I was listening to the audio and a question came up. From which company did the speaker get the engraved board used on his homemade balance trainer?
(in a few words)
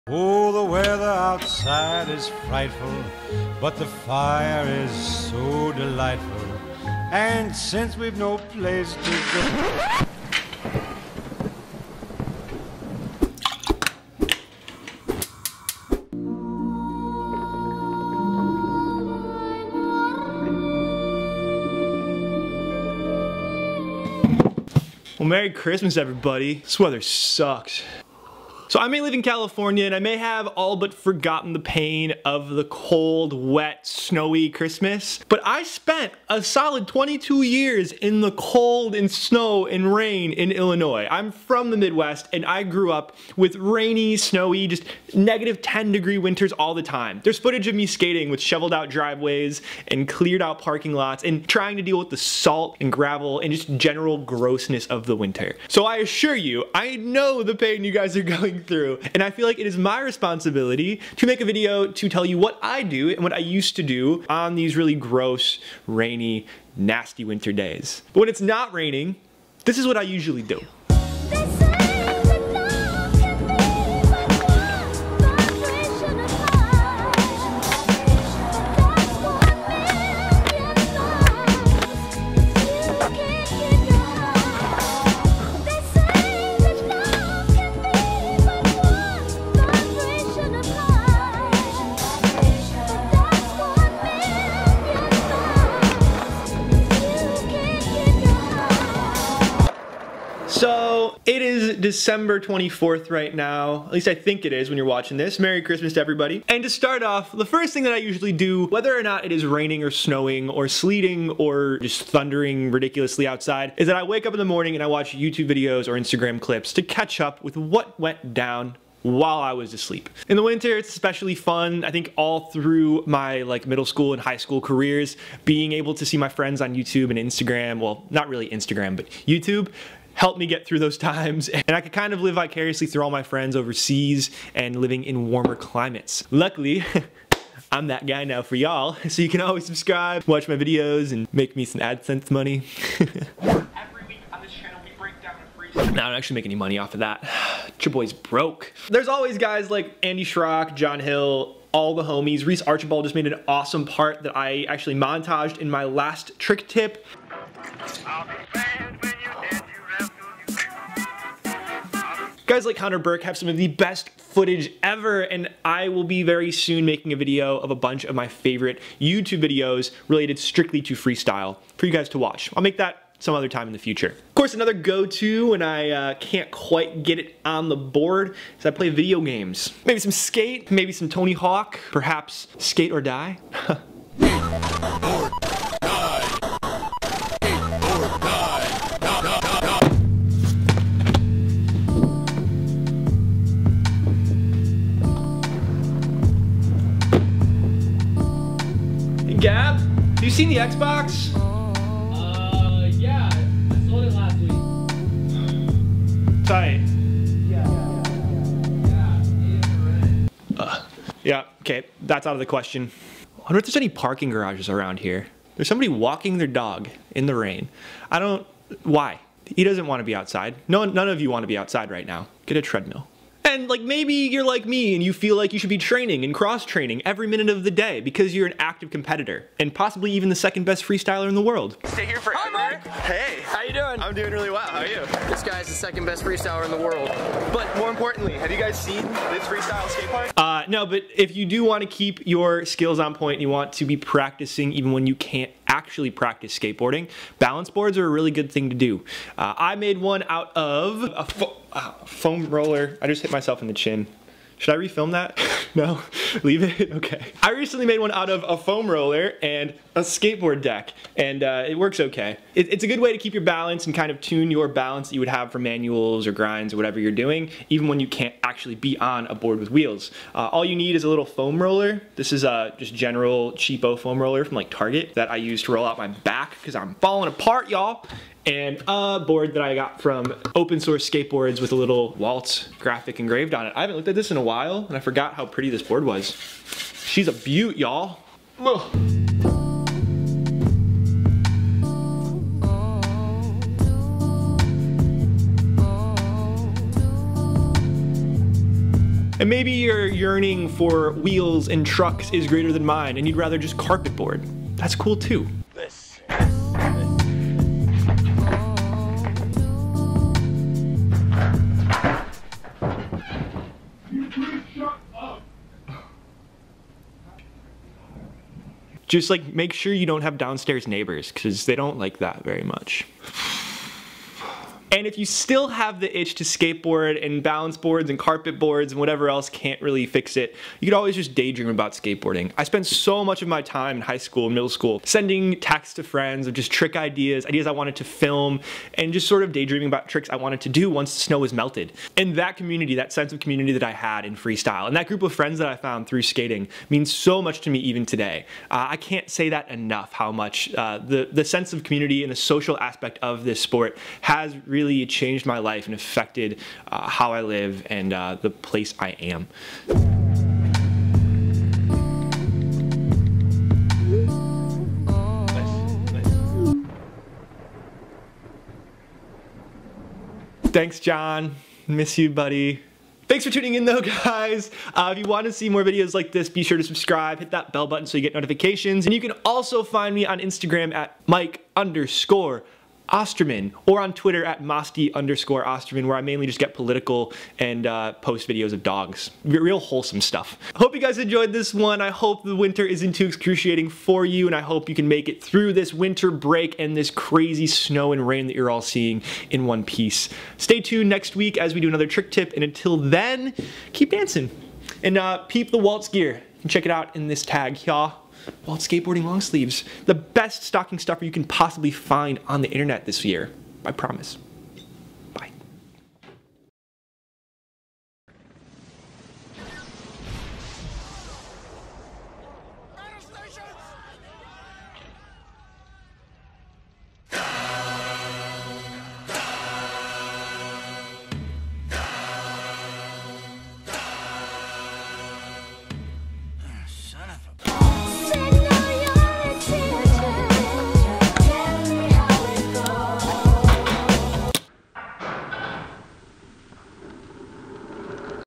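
Open Source Skateboards.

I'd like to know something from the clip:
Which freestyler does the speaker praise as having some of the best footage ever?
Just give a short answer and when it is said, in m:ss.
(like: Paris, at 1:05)
Connor Burke, at 2:42.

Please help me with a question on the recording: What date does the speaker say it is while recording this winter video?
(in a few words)
December 24th.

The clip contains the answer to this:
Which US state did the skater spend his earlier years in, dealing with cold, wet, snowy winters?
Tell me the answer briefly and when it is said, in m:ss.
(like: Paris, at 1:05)
Illinois, at 0:40.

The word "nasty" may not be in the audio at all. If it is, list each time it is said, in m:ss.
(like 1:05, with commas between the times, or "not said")
1:06.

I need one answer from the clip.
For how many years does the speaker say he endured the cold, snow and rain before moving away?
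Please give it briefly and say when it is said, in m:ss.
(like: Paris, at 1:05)
22, at 0:36.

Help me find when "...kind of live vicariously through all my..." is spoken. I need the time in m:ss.
2:11.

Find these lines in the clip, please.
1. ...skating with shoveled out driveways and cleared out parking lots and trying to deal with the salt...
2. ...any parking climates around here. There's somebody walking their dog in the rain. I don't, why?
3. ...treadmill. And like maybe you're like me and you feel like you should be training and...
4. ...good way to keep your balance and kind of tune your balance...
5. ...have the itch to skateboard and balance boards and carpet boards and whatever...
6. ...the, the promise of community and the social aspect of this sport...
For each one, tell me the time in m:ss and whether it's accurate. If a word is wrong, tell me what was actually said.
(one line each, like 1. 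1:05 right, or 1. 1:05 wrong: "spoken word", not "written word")
1. 0:47 right
2. 3:33 wrong: "garages", not "climates"
3. 3:42 right
4. 4:22 right
5. 5:25 right
6. 5:50 wrong: "sense", not "promise".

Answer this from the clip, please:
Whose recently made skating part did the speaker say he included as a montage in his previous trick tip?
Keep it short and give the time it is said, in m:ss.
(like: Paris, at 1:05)
Reese Archibald, at 2:32.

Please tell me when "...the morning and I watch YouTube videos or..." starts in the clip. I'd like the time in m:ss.
1:54.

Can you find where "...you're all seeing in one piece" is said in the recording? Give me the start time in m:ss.
6:38.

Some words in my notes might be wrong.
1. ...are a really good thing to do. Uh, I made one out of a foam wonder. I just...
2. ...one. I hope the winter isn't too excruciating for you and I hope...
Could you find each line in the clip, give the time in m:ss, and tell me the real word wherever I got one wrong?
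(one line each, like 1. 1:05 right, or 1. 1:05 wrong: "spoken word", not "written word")
1. 4:07 wrong: "roller", not "wonder"
2. 6:31 right.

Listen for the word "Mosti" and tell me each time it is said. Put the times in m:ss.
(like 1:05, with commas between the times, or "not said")
6:24.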